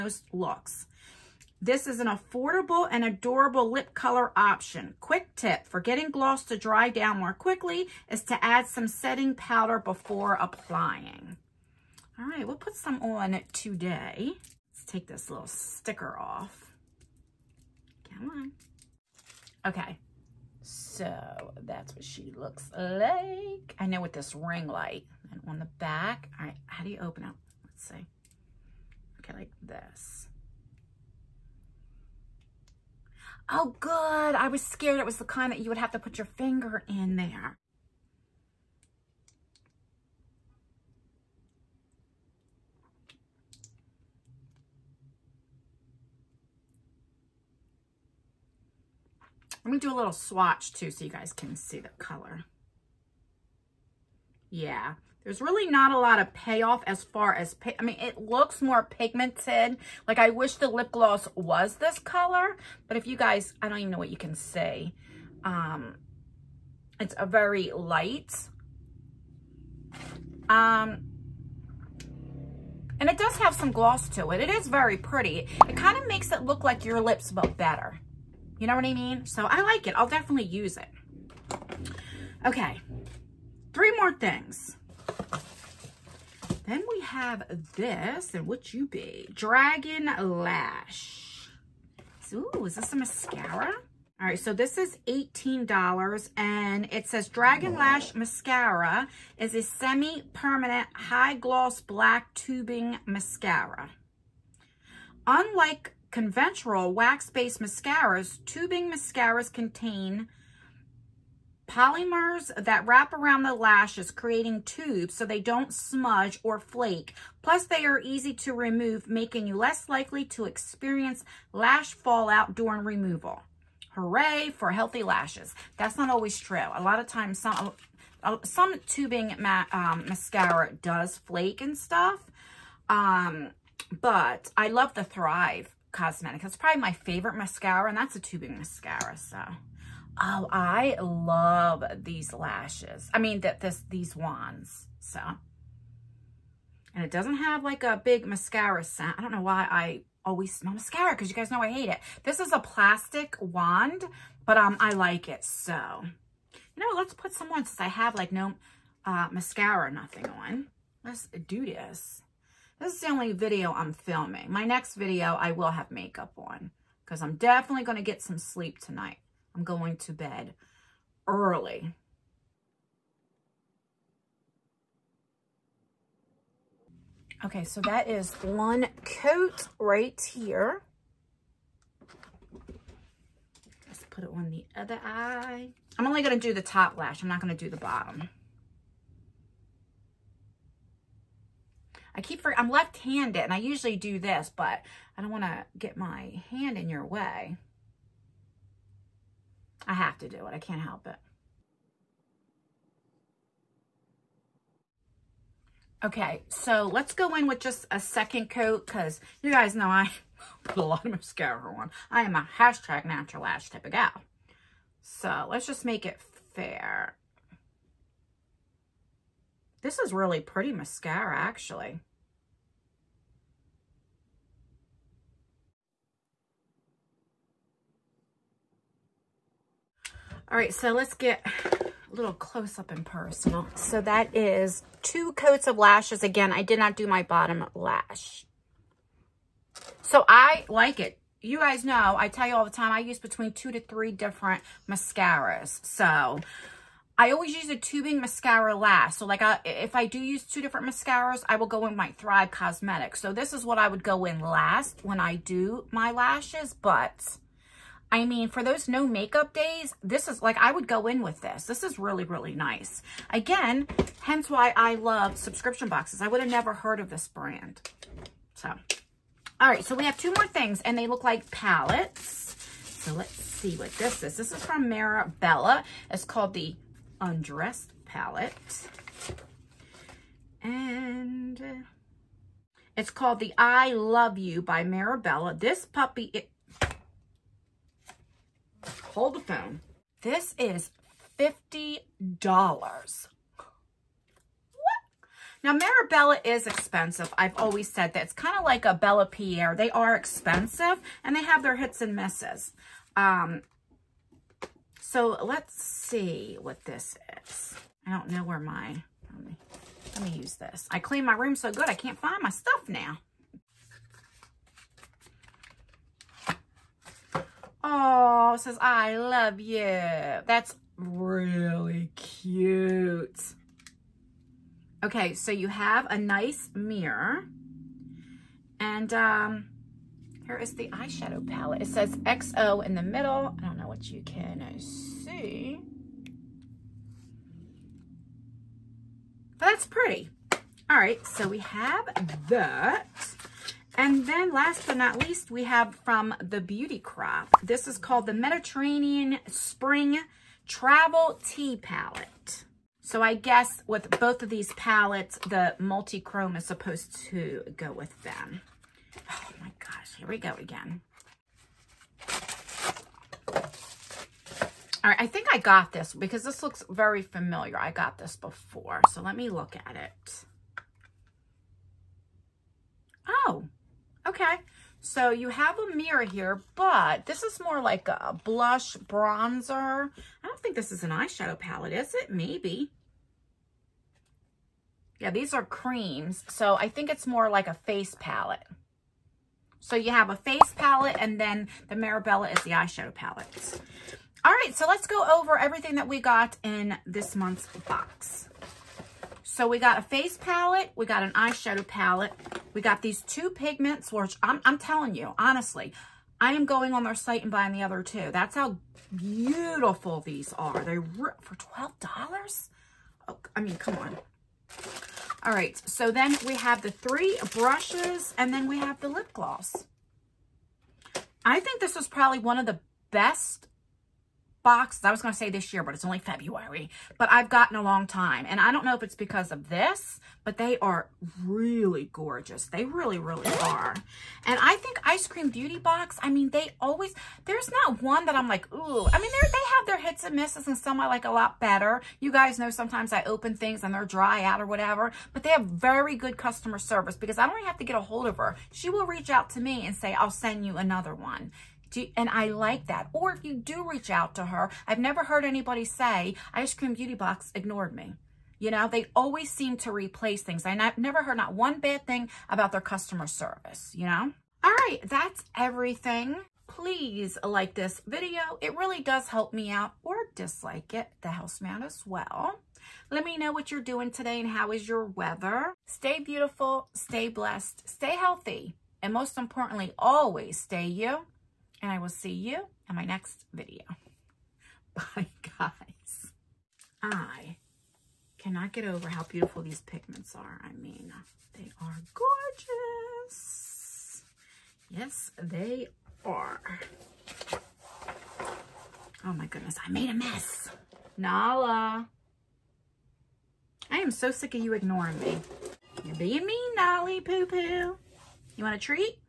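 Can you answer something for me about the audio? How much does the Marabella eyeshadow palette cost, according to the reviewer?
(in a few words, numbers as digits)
$50.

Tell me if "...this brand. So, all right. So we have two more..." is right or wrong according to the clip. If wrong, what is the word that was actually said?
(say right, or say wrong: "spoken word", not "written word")
right.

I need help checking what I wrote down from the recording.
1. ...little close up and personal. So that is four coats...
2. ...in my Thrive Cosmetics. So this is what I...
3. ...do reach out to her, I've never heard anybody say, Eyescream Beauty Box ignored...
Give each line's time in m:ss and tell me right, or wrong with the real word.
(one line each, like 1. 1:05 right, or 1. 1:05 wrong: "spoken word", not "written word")
1. 3:52 wrong: "two", not "four"
2. 4:11 right
3. 7:33 right.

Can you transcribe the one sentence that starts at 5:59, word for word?
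Oh gosh, here we go again.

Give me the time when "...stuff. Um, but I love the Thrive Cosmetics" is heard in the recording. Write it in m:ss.
2:11.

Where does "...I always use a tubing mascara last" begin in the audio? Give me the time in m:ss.
4:07.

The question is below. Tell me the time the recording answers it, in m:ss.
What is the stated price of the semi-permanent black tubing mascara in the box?
1:35.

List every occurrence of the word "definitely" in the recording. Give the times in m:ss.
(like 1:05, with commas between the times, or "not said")
1:20, 2:47.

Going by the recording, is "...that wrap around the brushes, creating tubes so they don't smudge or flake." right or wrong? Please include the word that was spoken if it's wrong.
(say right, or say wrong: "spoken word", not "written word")
wrong: "lashes", not "brushes".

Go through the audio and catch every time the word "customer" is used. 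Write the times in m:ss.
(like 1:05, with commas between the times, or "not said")
7:26, 7:42.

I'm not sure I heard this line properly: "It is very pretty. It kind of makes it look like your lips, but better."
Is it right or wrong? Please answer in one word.
right.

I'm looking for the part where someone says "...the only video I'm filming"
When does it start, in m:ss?
2:42.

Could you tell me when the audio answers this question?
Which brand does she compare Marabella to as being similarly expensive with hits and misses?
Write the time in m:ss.
4:58.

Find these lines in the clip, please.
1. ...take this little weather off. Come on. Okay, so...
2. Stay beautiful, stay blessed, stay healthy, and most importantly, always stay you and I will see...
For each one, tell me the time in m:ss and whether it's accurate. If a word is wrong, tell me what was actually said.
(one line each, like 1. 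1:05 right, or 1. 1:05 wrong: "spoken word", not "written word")
1. 0:14 wrong: "sticker", not "weather"
2. 7:55 right.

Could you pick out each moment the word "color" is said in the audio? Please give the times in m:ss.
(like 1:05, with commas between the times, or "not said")
0:03, 0:51, 1:01.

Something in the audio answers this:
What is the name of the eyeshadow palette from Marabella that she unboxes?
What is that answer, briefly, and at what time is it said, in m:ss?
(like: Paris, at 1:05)
Undressed palette, at 4:37.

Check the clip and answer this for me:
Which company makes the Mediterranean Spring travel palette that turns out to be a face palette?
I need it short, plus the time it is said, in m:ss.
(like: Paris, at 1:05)
the Beauty Crop, at 5:46.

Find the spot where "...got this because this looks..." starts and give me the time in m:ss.
6:05.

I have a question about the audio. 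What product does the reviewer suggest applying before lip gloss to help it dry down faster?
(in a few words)
setting powder.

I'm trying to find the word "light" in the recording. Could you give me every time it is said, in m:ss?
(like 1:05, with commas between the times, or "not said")
0:24, 1:07.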